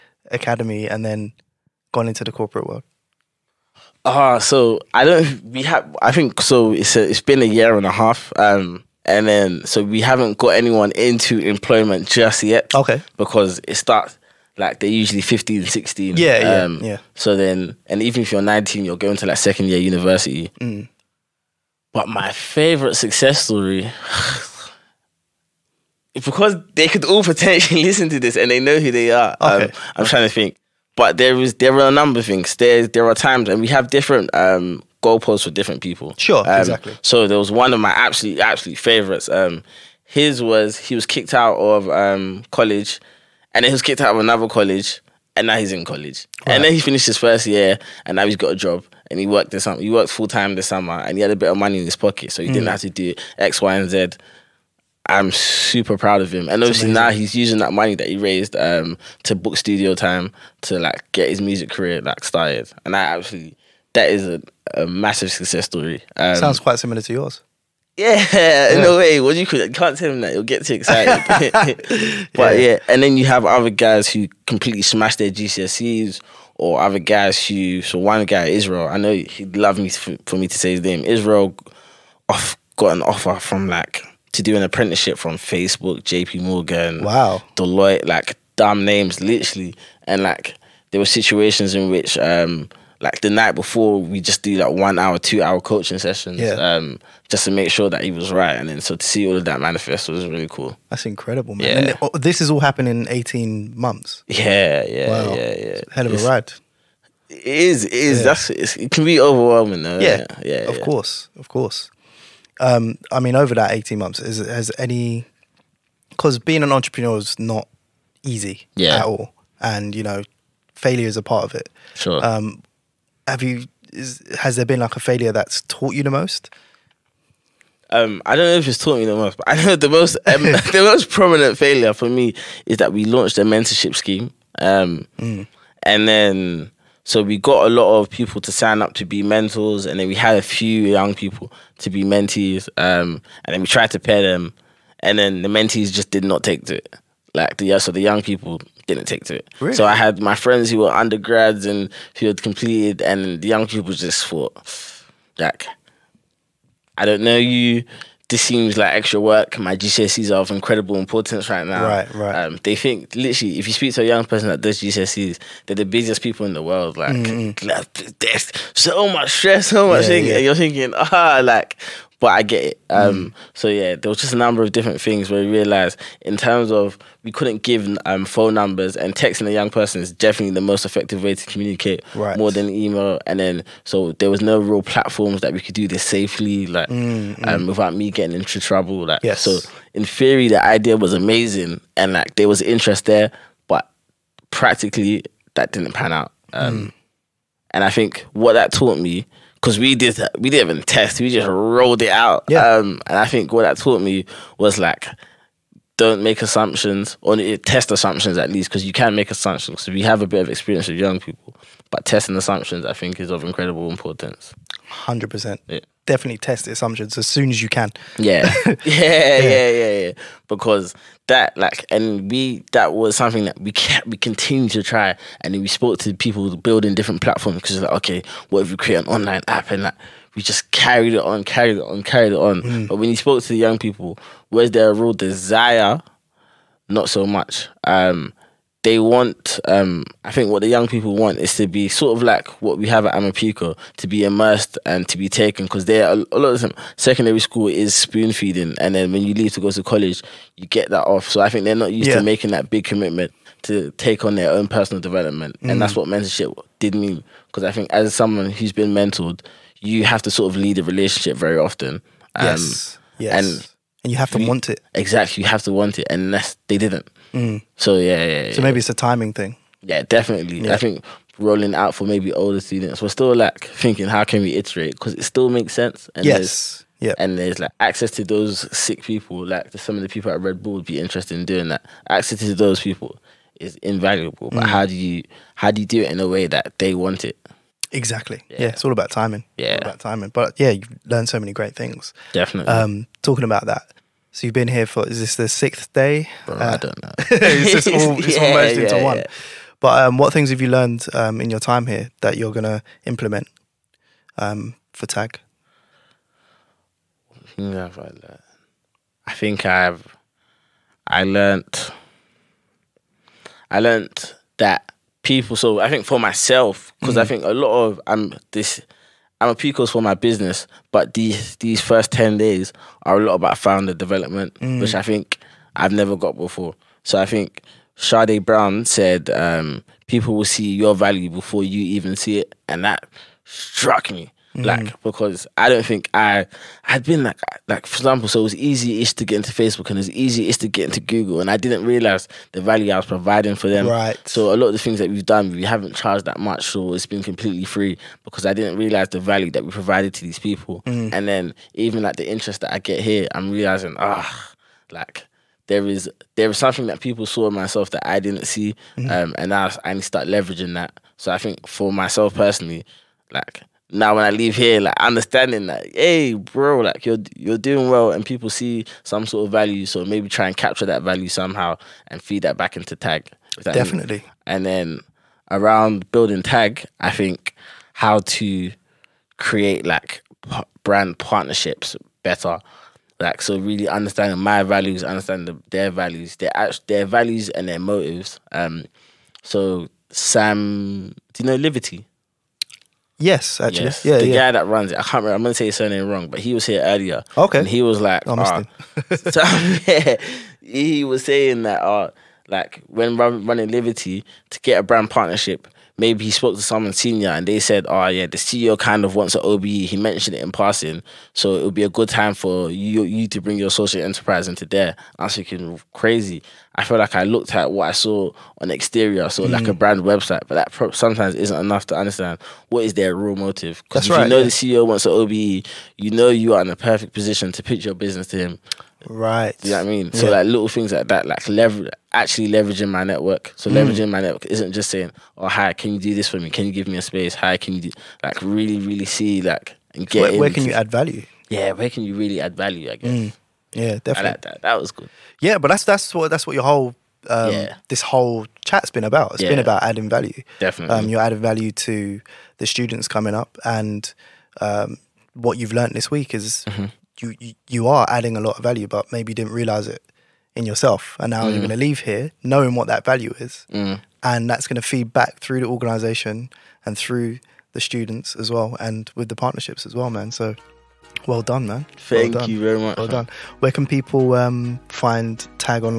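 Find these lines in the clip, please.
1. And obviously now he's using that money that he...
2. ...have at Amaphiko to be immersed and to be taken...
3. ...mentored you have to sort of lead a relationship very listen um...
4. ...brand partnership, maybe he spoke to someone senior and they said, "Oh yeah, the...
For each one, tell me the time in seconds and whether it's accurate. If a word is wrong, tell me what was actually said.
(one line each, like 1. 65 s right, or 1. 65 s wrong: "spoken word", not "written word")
1. 56 s right
2. 242 s right
3. 258 s wrong: "often", not "listen"
4. 404 s right.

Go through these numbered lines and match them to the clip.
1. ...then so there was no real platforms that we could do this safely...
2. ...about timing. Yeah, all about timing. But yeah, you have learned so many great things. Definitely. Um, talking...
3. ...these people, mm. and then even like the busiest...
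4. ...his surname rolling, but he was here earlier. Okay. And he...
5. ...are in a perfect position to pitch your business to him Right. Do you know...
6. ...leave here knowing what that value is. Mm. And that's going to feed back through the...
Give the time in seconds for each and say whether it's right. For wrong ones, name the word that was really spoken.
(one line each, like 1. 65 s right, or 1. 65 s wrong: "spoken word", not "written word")
1. 183 s right
2. 288 s right
3. 350 s wrong: "interest", not "busiest"
4. 395 s wrong: "wrong", not "rolling"
5. 426 s right
6. 461 s right.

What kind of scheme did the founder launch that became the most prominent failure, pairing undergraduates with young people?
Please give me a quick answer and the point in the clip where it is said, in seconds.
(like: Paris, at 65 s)
a mentorship scheme, at 133 s.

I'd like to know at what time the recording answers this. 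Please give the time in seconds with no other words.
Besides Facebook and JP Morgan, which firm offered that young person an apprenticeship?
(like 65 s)
87 s.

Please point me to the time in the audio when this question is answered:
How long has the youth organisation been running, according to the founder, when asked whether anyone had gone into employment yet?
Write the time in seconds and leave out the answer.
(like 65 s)
7 s.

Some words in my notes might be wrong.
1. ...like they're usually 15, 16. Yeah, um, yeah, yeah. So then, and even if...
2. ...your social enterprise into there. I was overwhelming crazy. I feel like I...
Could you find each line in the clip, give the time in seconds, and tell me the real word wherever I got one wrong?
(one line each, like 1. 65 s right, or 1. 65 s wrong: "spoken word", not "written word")
1. 14 s right
2. 413 s wrong: "thinking", not "overwhelming".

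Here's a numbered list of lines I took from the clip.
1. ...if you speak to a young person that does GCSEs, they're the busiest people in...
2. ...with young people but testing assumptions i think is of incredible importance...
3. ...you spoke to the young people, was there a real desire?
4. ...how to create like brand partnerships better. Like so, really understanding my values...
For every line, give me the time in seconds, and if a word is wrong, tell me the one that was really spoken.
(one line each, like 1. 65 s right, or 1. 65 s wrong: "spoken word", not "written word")
1. 163 s right
2. 210 s right
3. 233 s right
4. 377 s right.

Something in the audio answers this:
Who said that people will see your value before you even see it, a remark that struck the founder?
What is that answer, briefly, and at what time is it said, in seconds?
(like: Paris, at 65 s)
Sade Brown, at 327 s.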